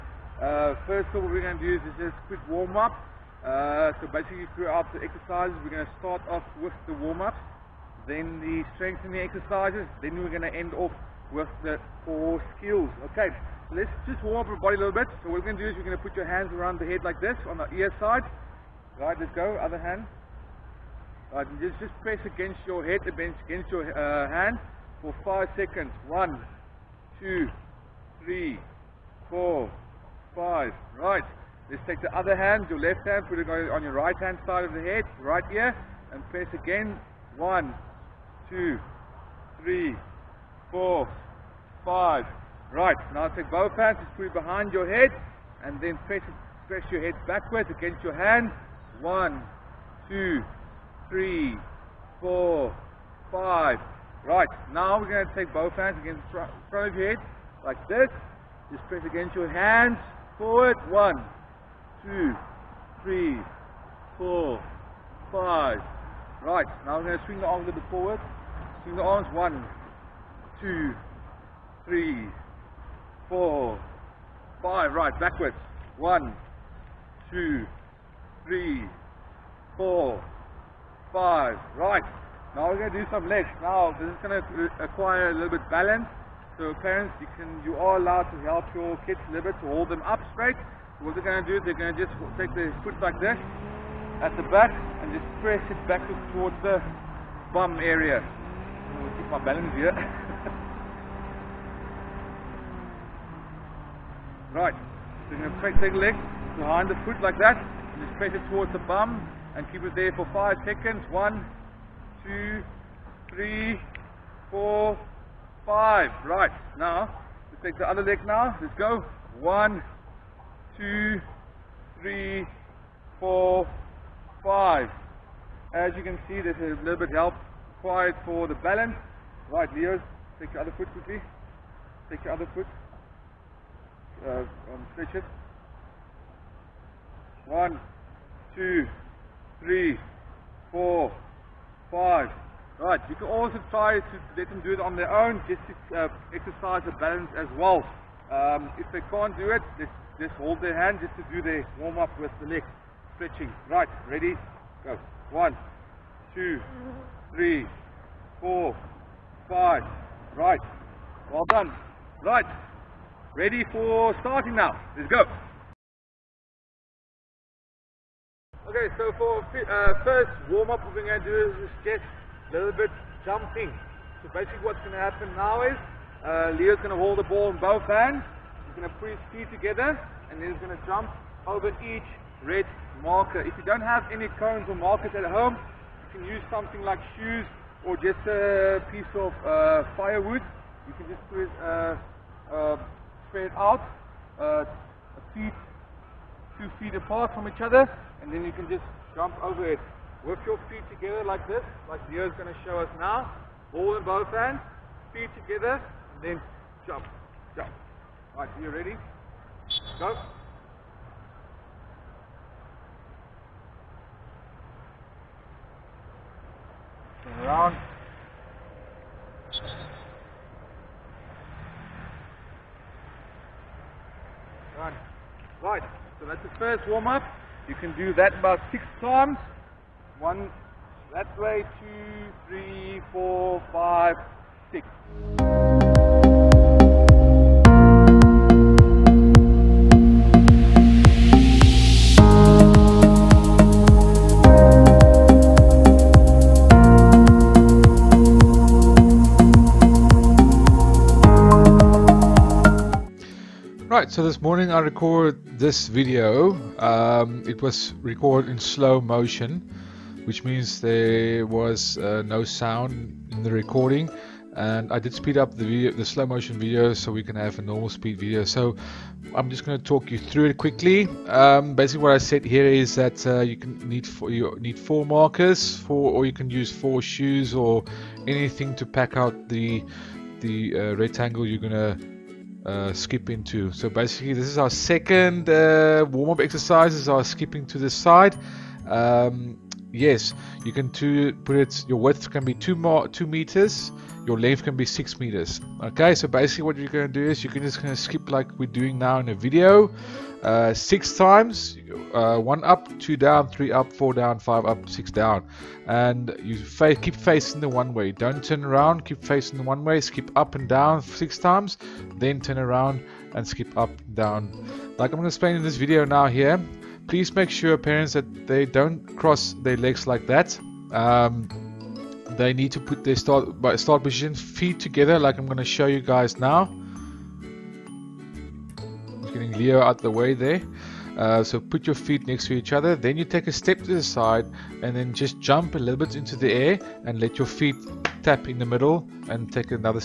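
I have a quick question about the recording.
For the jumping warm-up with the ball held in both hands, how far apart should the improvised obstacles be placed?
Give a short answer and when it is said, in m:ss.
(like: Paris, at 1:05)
2 feet, at 3:16.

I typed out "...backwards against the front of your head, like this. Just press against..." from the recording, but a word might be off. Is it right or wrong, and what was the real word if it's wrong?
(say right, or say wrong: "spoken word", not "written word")
wrong: "hands", not "backwards".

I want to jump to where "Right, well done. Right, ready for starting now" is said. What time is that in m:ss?
2:40.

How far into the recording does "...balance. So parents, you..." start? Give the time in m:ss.
1:25.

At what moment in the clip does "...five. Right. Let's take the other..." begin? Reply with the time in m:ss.
0:30.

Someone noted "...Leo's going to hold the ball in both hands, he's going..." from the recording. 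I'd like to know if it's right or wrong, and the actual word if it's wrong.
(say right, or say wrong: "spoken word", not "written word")
right.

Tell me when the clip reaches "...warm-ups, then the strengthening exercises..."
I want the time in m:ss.
0:06.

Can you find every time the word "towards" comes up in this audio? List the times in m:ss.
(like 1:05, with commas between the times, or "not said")
1:36, 1:48.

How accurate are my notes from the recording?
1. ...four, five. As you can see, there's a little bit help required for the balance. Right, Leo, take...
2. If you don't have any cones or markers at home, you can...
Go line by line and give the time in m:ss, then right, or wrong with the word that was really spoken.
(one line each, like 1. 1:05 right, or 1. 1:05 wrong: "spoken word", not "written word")
1. 2:03 right
2. 3:03 right.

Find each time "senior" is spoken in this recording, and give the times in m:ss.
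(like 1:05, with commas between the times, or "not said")
not said.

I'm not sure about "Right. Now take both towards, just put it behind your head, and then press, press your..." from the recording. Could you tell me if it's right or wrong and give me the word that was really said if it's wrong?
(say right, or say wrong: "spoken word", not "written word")
wrong: "hands", not "towards".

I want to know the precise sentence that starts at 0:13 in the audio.
Okay, so let's just warm up our body a little bit.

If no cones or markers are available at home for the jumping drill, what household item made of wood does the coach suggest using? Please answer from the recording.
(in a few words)
firewood.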